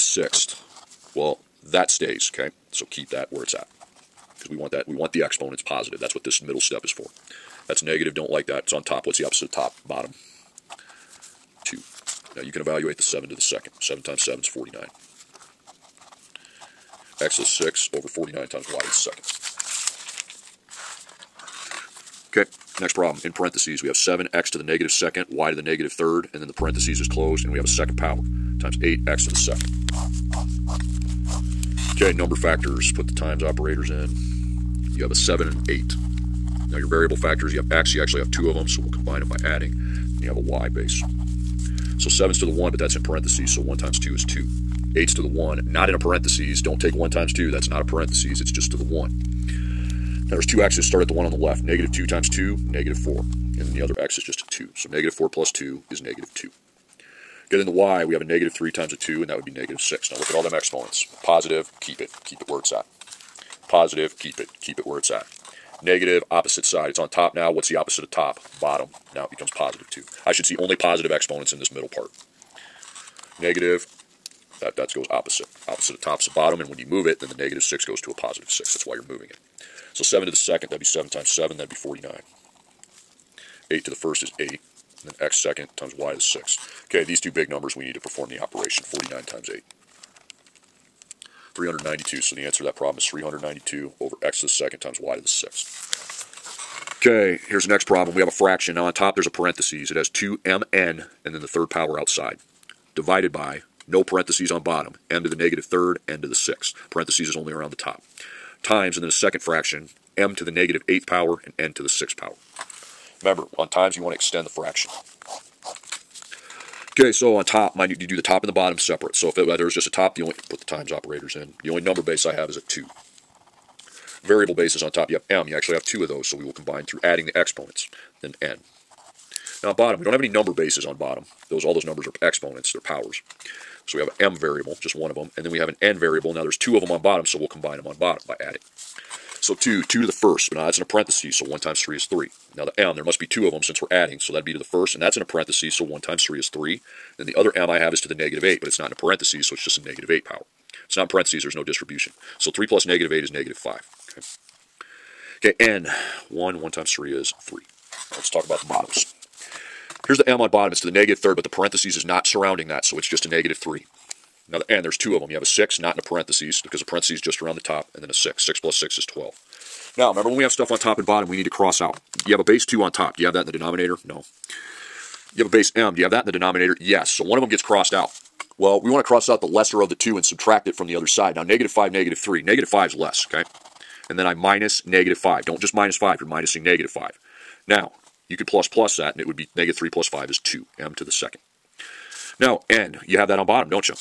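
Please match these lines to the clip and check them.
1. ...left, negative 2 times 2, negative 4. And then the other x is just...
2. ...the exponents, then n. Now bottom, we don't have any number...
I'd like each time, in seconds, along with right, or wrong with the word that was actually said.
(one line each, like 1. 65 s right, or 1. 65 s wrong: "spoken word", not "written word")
1. 51 s right
2. 127 s right.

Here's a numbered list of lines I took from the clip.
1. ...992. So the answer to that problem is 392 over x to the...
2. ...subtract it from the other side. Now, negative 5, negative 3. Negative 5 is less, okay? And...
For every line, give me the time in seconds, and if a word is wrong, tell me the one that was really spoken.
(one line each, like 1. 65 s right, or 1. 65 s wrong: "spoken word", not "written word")
1. 91 s wrong: "392", not "992"
2. 180 s right.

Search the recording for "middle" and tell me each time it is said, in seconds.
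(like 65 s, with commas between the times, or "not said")
6 s, 71 s.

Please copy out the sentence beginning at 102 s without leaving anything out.
Divided by, no parentheses on bottom, m to the negative third, n to the sixth.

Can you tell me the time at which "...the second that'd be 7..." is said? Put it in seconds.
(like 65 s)
80 s.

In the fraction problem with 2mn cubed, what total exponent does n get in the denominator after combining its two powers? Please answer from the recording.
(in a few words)
12.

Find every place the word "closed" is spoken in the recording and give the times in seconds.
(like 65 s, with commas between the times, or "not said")
27 s.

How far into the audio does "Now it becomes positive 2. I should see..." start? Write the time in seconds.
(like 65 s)
69 s.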